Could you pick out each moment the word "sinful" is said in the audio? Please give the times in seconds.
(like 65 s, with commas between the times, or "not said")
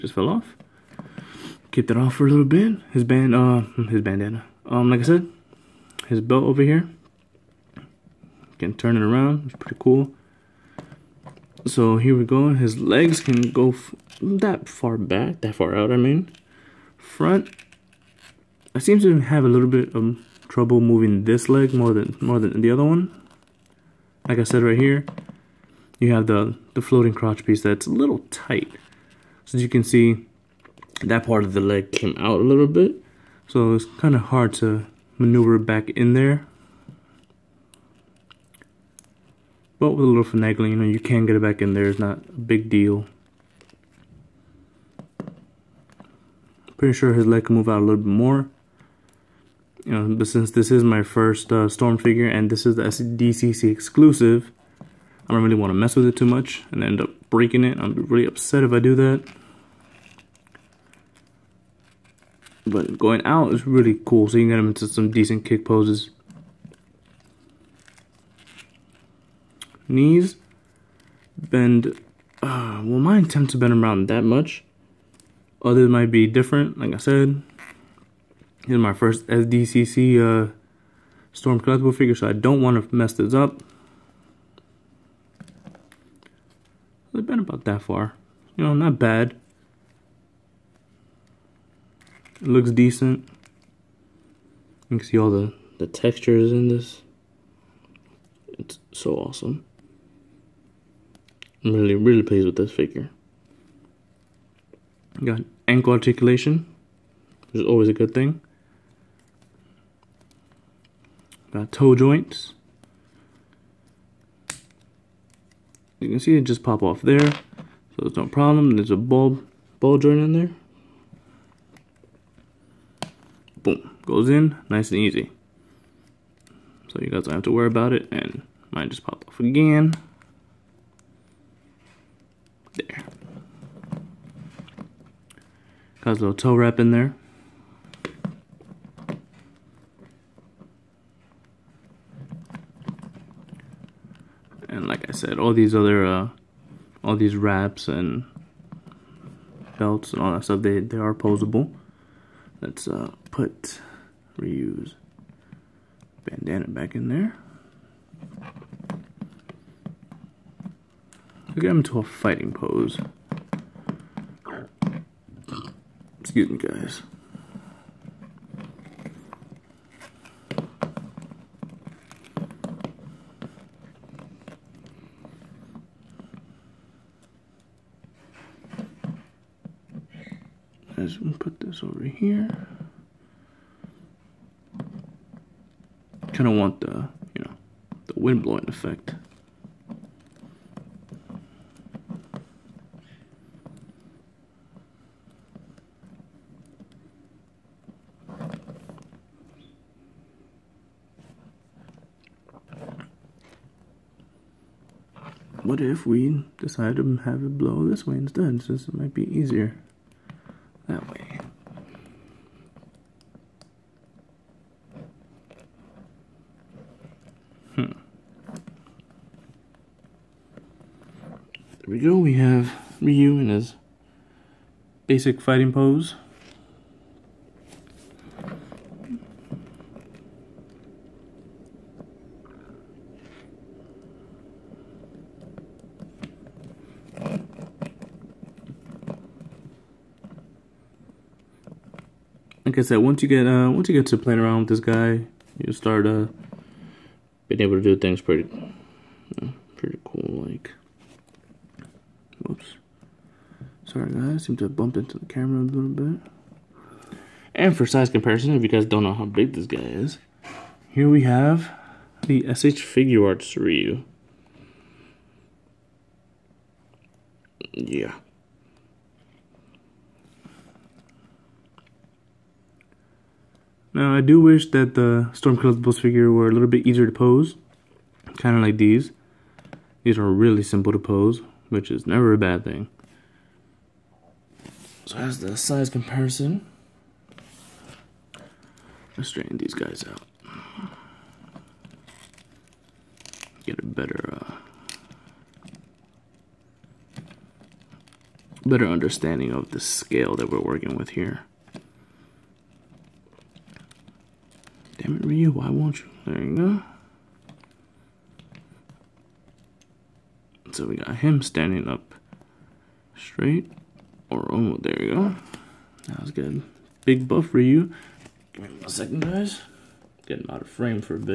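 not said.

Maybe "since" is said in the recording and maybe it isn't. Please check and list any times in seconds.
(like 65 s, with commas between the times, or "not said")
50 s, 208 s.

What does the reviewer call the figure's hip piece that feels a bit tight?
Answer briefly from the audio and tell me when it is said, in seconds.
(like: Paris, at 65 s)
Floating crotch piece, at 26 s.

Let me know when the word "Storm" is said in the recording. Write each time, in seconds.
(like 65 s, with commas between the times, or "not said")
51 s, 81 s, 275 s.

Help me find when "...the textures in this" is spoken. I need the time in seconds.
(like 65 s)
95 s.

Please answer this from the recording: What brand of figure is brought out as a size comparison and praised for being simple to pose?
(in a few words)
SH Figuarts.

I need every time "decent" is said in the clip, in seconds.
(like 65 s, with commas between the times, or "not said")
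65 s, 92 s.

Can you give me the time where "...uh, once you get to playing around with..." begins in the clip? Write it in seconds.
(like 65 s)
243 s.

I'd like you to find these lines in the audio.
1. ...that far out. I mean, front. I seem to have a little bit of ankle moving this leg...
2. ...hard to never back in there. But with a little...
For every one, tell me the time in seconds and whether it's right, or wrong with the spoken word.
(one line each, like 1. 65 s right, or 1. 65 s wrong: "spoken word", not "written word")
1. 15 s wrong: "trouble", not "ankle"
2. 34 s wrong: "maneuver", not "never".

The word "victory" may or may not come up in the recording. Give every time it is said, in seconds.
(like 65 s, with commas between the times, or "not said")
not said.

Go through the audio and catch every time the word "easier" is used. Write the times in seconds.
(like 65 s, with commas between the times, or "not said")
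209 s, 276 s.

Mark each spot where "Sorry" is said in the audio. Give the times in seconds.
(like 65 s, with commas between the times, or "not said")
253 s.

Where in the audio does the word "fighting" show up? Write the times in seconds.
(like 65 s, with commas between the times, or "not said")
162 s, 225 s.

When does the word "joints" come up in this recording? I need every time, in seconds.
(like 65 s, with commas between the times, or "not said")
111 s, 120 s.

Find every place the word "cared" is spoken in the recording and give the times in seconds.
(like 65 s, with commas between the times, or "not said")
not said.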